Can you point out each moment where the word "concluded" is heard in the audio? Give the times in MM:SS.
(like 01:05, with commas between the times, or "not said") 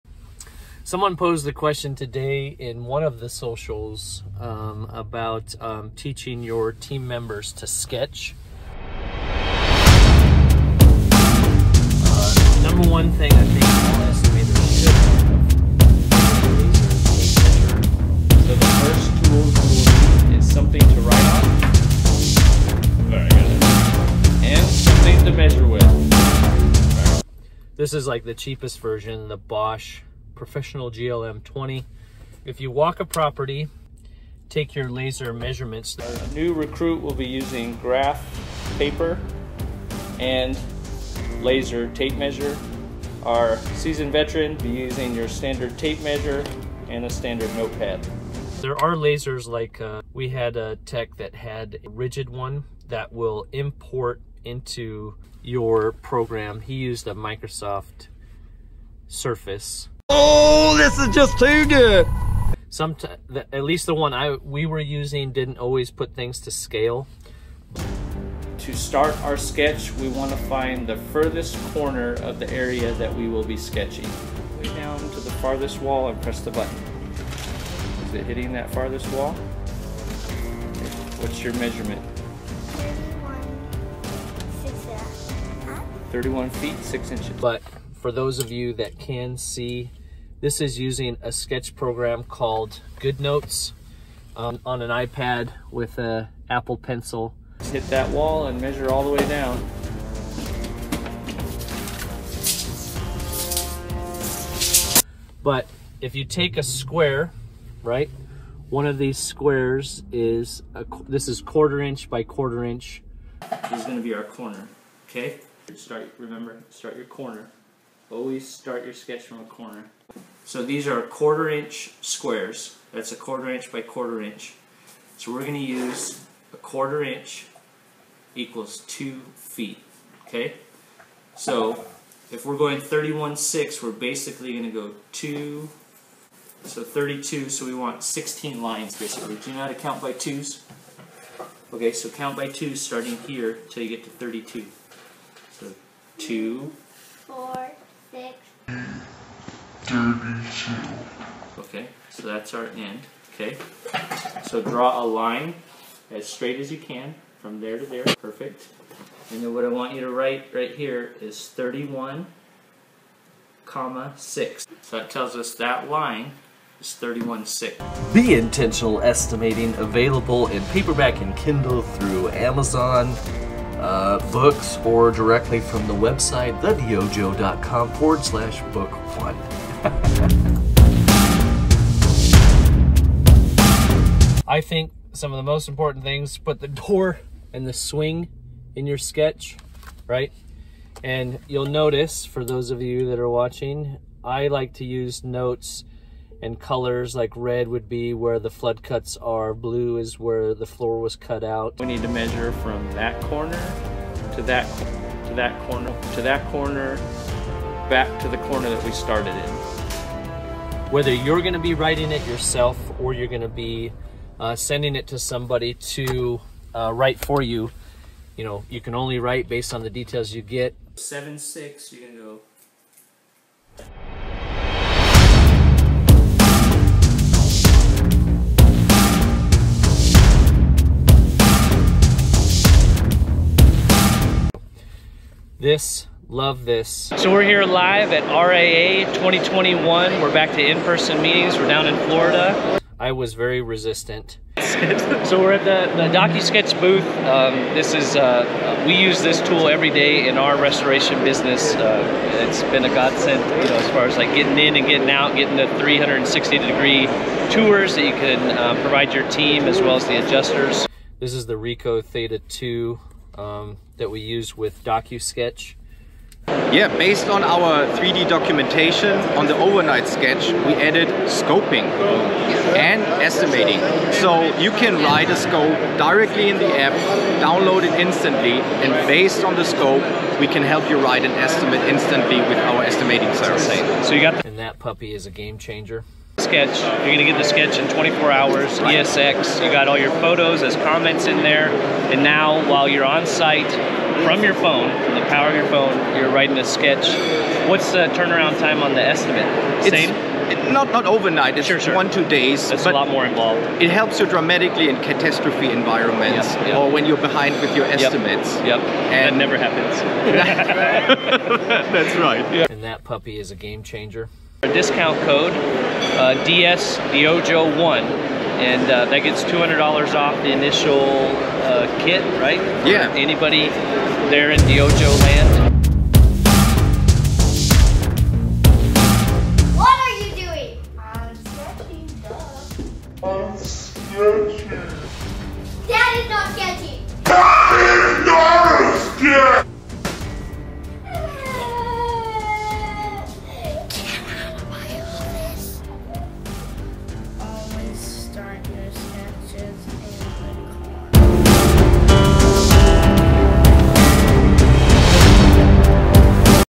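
not said.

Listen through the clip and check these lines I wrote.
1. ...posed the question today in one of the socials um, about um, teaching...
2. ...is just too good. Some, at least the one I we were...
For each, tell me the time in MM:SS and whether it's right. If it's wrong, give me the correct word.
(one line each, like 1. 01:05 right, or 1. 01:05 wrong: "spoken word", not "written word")
1. 00:01 right
2. 01:00 right.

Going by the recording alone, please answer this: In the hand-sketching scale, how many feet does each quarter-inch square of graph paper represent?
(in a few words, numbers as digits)
2 feet.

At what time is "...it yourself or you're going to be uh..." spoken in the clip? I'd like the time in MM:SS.
03:32.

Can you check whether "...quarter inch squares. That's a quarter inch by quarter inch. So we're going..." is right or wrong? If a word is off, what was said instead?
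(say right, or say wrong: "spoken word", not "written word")
right.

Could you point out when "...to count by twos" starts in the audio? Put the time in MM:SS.
02:19.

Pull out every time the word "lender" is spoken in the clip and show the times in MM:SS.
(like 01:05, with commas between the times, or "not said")
not said.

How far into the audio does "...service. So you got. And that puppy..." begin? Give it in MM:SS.
04:43.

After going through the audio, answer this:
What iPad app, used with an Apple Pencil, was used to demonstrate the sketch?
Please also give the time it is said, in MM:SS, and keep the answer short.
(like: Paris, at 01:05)
GoodNotes, at 01:32.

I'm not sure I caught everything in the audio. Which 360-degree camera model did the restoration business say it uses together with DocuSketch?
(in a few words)
Ricoh Theta 2.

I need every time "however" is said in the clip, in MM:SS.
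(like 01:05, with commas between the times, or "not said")
not said.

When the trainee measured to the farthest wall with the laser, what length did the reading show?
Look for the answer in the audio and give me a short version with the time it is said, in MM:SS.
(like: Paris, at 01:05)
31 feet, 6 inches, at 01:26.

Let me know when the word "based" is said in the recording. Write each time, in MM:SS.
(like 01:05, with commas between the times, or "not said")
03:39, 04:26, 04:39.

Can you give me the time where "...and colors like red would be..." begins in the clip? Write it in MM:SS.
03:16.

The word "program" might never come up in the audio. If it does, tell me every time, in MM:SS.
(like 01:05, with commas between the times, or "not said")
00:55, 01:31.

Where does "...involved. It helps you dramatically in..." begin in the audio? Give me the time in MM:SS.
05:03.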